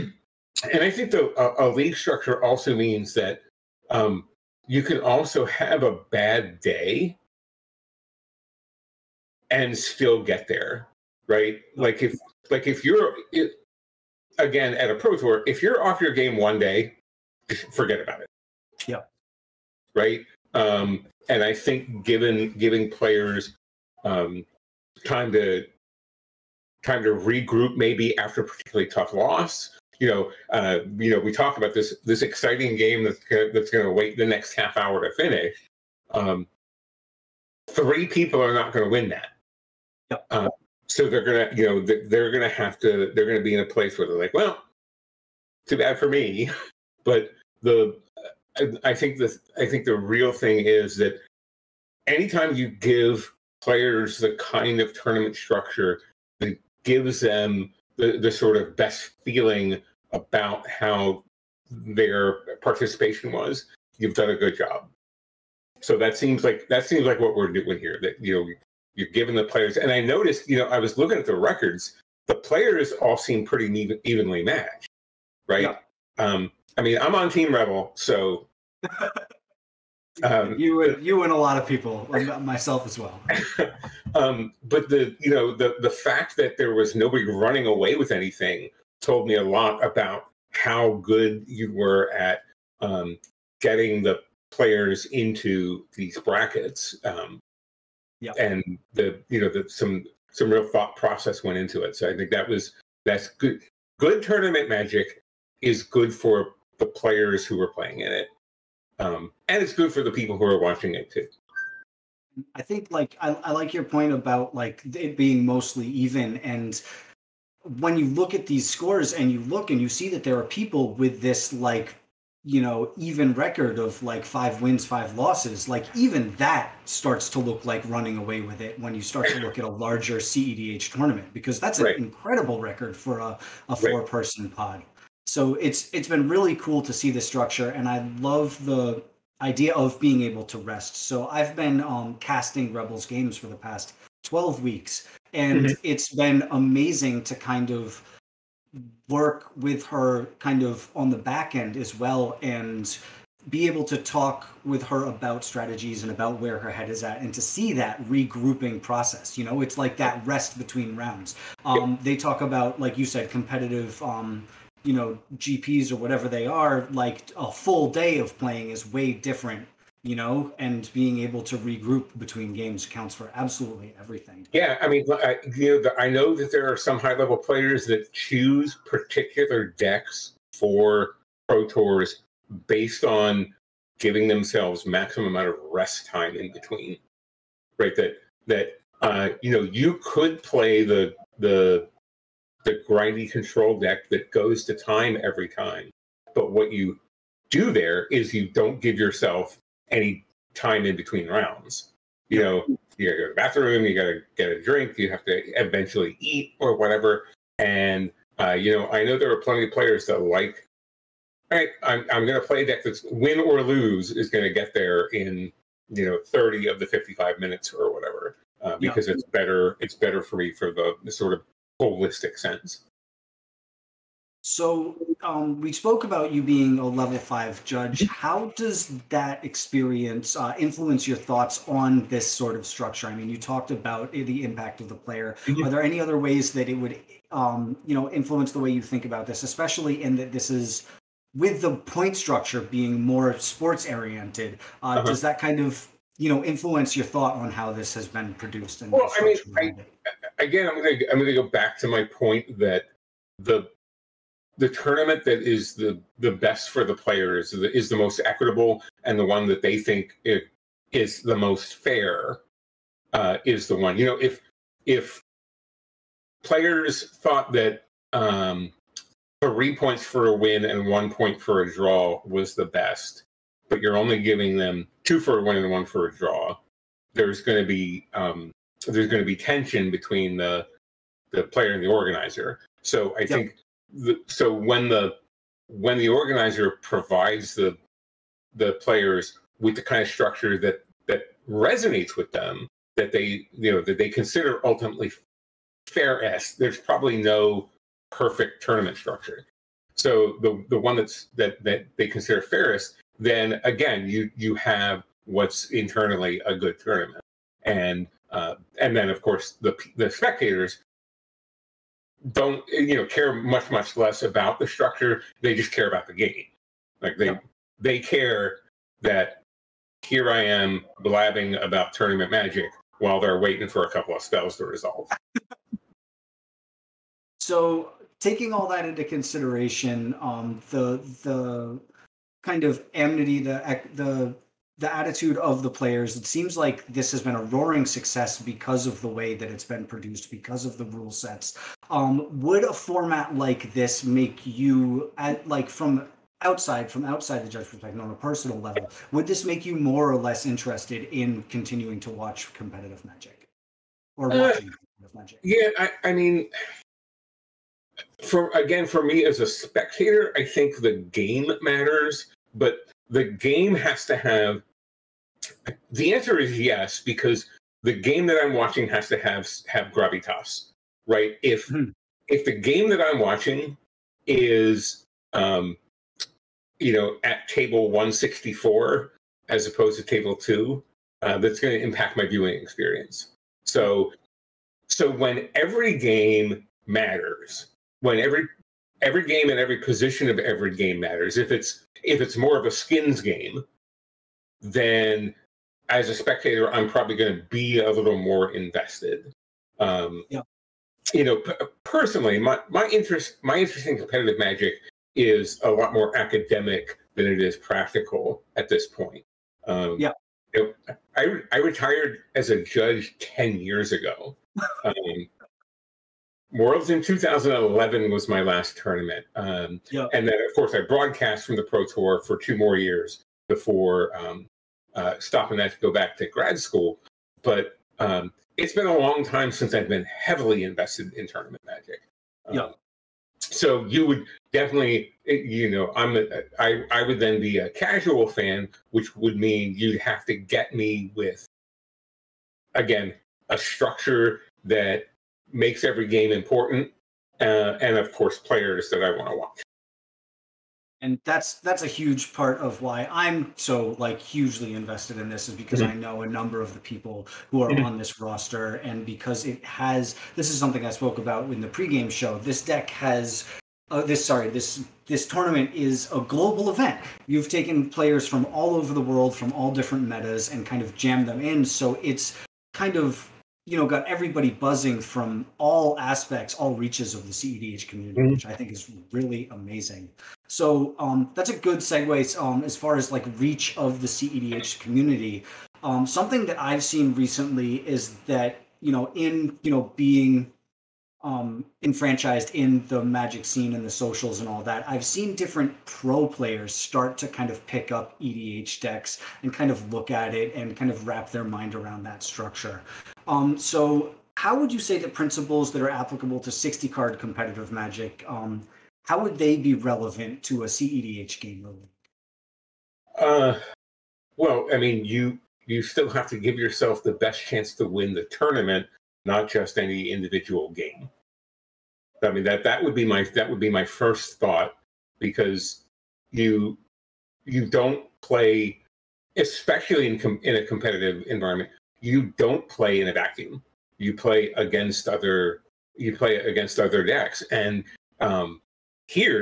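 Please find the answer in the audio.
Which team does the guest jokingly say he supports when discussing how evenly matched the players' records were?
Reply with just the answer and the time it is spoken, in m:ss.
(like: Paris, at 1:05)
Team Rebel, at 1:17.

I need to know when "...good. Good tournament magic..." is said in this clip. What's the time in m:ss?
1:43.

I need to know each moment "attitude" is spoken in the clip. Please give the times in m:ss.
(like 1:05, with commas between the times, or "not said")
5:34.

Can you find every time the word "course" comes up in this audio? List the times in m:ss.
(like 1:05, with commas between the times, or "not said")
5:09, 7:00, 7:28.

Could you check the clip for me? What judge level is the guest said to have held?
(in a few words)
level five.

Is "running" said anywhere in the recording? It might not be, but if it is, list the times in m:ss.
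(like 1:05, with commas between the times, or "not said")
1:27, 2:07.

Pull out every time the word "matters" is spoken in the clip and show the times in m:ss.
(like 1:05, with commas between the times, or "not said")
6:01, 6:26, 6:30.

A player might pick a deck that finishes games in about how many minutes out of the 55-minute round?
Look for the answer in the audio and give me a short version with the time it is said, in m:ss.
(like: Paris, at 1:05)
30, at 3:36.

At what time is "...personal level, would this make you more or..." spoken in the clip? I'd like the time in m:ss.
5:48.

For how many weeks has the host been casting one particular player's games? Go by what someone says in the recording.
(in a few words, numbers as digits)
12.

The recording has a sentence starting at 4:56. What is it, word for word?
There's probably no perfect tournament structure.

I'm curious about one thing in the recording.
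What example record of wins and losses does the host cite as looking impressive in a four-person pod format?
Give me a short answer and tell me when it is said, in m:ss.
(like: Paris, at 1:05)
5 wins 5 losses, at 2:04.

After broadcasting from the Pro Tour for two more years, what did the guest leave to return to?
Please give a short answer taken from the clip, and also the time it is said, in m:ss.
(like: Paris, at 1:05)
grad school, at 7:06.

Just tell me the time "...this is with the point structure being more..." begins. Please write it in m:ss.
4:00.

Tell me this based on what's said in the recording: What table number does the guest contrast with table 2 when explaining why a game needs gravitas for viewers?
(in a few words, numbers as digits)
164.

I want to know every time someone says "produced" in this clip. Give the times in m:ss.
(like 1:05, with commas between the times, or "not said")
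4:08, 5:39.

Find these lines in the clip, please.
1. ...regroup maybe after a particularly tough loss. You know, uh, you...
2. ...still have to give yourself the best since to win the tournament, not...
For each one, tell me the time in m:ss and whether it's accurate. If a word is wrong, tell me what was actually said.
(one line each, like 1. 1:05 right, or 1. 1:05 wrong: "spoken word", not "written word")
1. 0:27 right
2. 8:35 wrong: "chance", not "since".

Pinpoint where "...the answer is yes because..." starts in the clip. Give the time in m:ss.
6:05.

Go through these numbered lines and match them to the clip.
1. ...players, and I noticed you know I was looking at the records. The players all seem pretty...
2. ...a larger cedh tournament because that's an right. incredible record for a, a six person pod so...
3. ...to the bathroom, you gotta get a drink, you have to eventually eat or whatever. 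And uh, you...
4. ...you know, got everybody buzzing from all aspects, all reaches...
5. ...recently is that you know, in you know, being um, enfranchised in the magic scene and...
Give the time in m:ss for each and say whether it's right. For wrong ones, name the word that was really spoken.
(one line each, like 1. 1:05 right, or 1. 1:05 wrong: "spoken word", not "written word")
1. 1:09 right
2. 2:09 wrong: "four", not "six"
3. 3:23 right
4. 7:53 right
5. 8:07 right.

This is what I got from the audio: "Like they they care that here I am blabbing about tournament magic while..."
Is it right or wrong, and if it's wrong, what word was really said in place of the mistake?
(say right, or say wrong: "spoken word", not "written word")
right.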